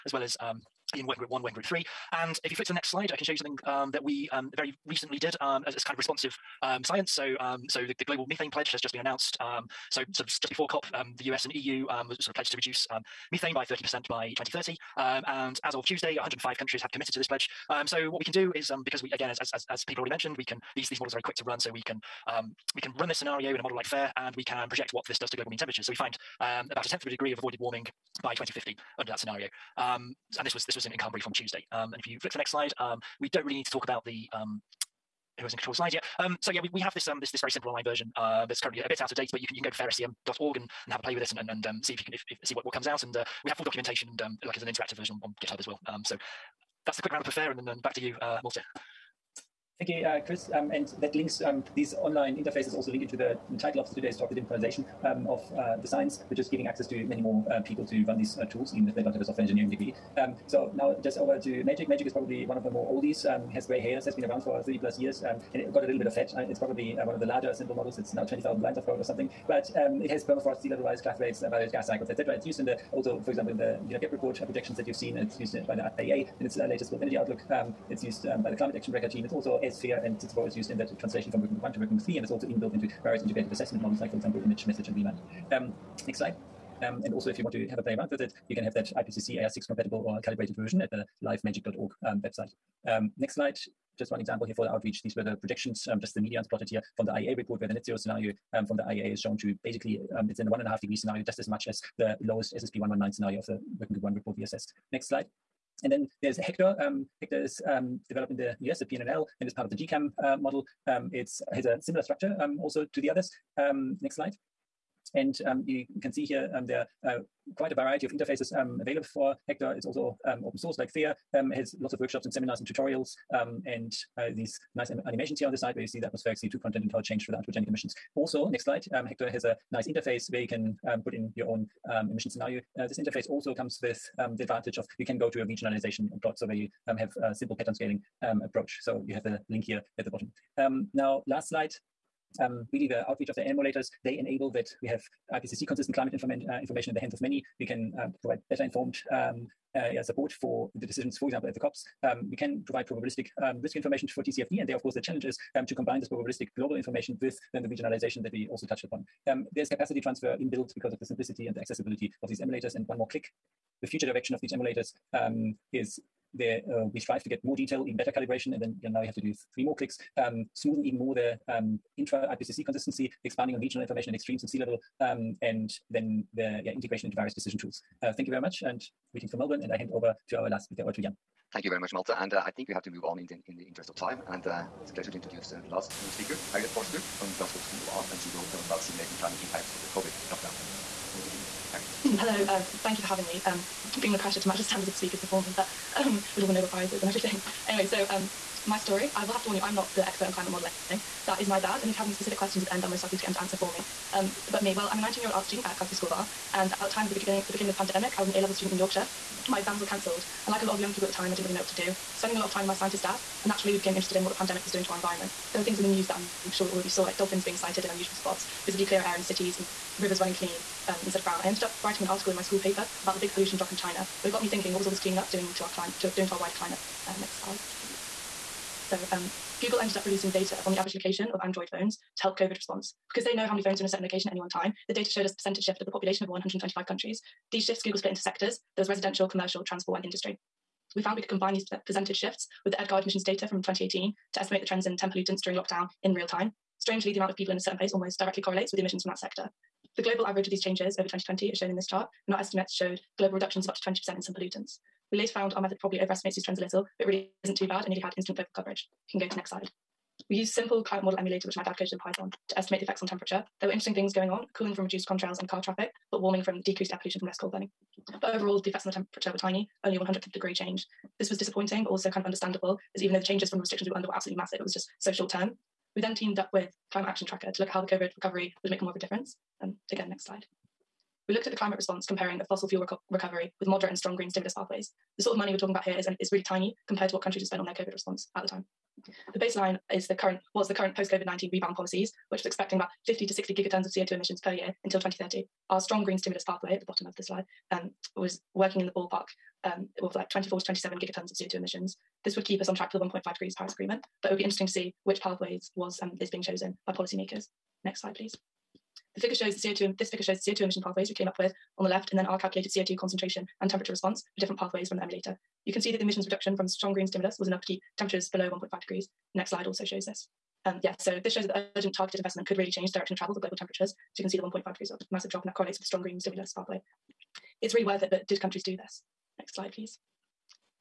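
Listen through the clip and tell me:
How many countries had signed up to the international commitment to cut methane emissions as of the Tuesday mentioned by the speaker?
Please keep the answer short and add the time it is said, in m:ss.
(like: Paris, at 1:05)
105, at 0:16.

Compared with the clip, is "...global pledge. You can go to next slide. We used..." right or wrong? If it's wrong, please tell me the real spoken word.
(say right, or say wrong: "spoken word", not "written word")
wrong: "coverage", not "pledge".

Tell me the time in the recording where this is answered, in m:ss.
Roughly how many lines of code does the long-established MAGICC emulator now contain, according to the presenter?
1:08.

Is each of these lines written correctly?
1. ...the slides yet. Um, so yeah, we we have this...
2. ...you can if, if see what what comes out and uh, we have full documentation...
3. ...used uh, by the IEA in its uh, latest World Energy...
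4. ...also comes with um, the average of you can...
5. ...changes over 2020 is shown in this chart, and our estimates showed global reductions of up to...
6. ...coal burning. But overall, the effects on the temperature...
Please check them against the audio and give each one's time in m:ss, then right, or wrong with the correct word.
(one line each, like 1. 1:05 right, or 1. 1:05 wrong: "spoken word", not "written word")
1. 0:35 right
2. 0:42 right
3. 1:15 right
4. 2:13 wrong: "advantage", not "average"
5. 4:10 right
6. 4:27 right.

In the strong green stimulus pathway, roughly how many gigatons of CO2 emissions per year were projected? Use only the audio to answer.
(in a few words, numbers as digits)
24 to 27.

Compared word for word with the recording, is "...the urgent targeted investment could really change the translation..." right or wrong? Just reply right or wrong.
wrong.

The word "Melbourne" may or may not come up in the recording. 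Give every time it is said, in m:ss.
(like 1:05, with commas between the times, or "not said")
2:59.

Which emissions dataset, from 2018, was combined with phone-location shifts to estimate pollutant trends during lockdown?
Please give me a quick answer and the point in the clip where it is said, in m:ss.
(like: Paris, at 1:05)
EDGAR, at 4:02.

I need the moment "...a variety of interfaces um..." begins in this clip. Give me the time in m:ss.
1:57.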